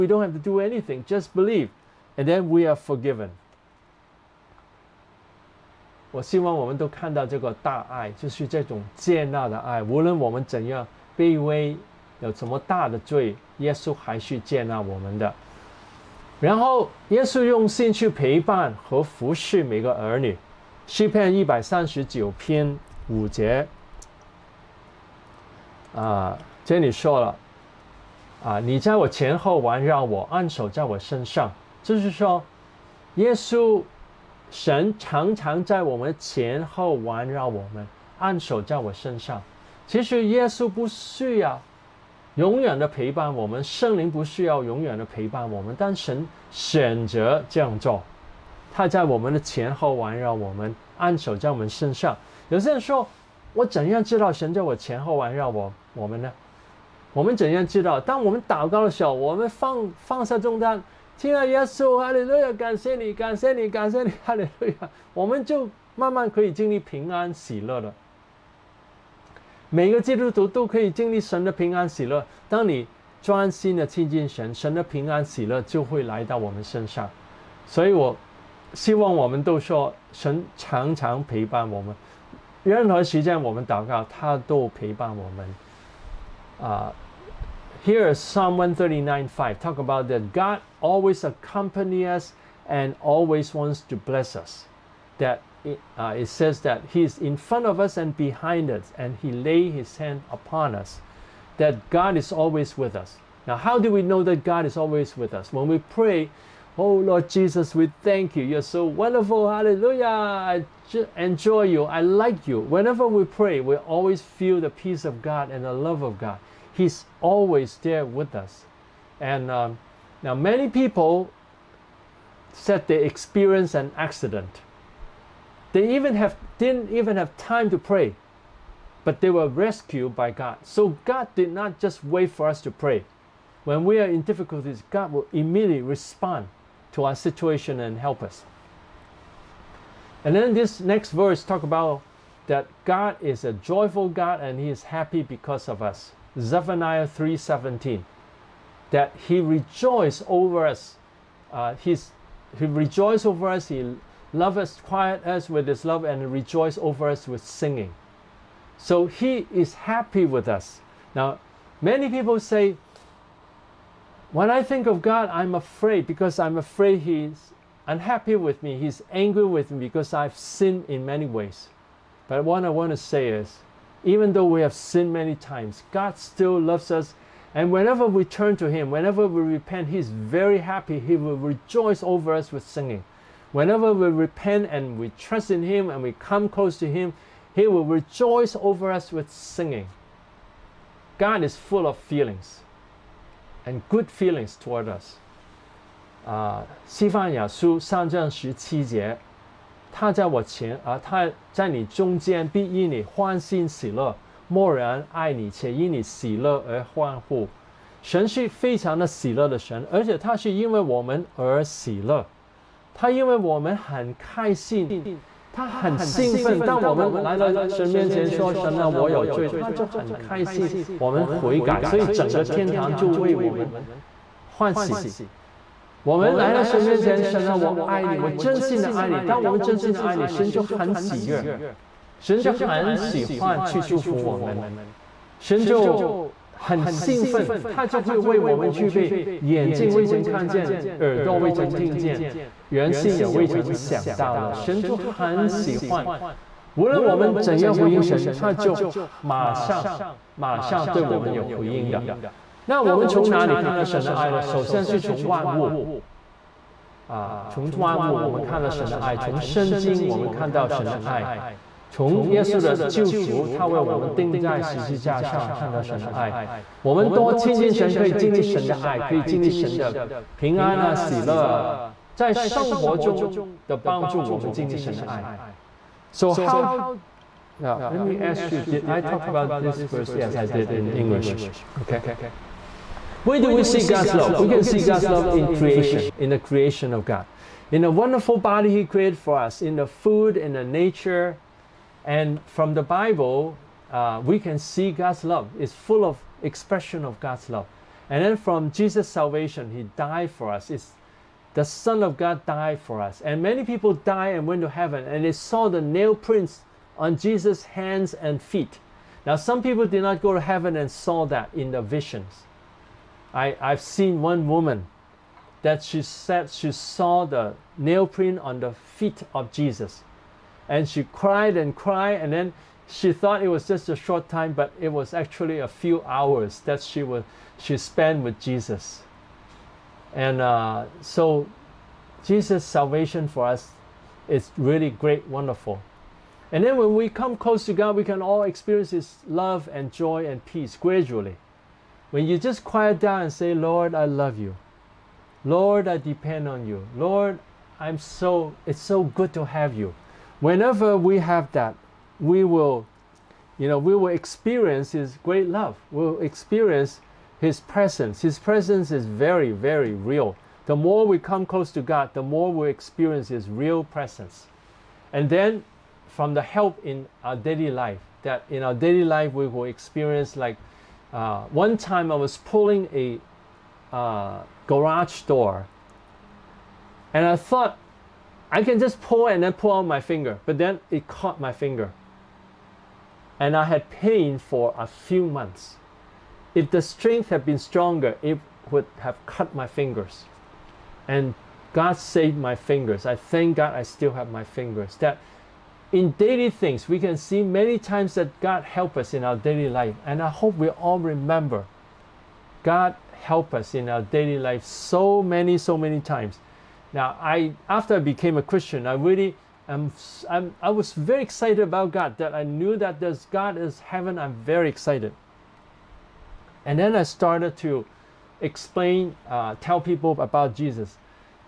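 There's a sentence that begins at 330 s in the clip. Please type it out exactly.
And uh, so Jesus' salvation for us is really great, wonderful.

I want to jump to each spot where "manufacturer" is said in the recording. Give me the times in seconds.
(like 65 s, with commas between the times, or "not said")
not said.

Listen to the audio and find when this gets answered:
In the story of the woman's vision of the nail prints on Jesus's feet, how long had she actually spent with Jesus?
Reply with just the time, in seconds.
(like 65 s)
325 s.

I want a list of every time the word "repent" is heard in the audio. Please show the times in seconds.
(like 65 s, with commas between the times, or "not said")
179 s, 184 s.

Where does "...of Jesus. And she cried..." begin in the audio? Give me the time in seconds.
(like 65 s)
319 s.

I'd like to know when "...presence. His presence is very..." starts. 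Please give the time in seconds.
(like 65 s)
357 s.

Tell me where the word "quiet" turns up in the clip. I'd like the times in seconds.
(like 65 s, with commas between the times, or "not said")
154 s, 342 s.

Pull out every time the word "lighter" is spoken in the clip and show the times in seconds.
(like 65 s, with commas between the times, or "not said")
not said.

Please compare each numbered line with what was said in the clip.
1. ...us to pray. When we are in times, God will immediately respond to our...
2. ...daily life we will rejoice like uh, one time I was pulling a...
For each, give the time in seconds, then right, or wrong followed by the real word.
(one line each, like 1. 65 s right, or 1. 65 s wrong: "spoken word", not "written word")
1. 132 s wrong: "difficulties", not "times"
2. 368 s wrong: "experience", not "rejoice".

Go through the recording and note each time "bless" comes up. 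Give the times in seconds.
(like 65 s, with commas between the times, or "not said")
93 s.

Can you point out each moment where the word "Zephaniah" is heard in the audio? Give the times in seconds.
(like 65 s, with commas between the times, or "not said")
146 s.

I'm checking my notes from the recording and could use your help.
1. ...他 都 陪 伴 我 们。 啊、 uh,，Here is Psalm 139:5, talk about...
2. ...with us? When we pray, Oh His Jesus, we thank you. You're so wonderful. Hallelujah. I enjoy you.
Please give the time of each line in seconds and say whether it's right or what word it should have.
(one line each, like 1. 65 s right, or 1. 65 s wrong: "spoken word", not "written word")
1. 84 s right
2. 105 s wrong: "Lord", not "His".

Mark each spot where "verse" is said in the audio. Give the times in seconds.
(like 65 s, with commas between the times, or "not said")
141 s, 279 s.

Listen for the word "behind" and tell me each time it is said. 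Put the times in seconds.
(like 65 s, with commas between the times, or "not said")
98 s.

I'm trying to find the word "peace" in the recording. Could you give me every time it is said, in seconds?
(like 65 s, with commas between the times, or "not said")
114 s, 340 s.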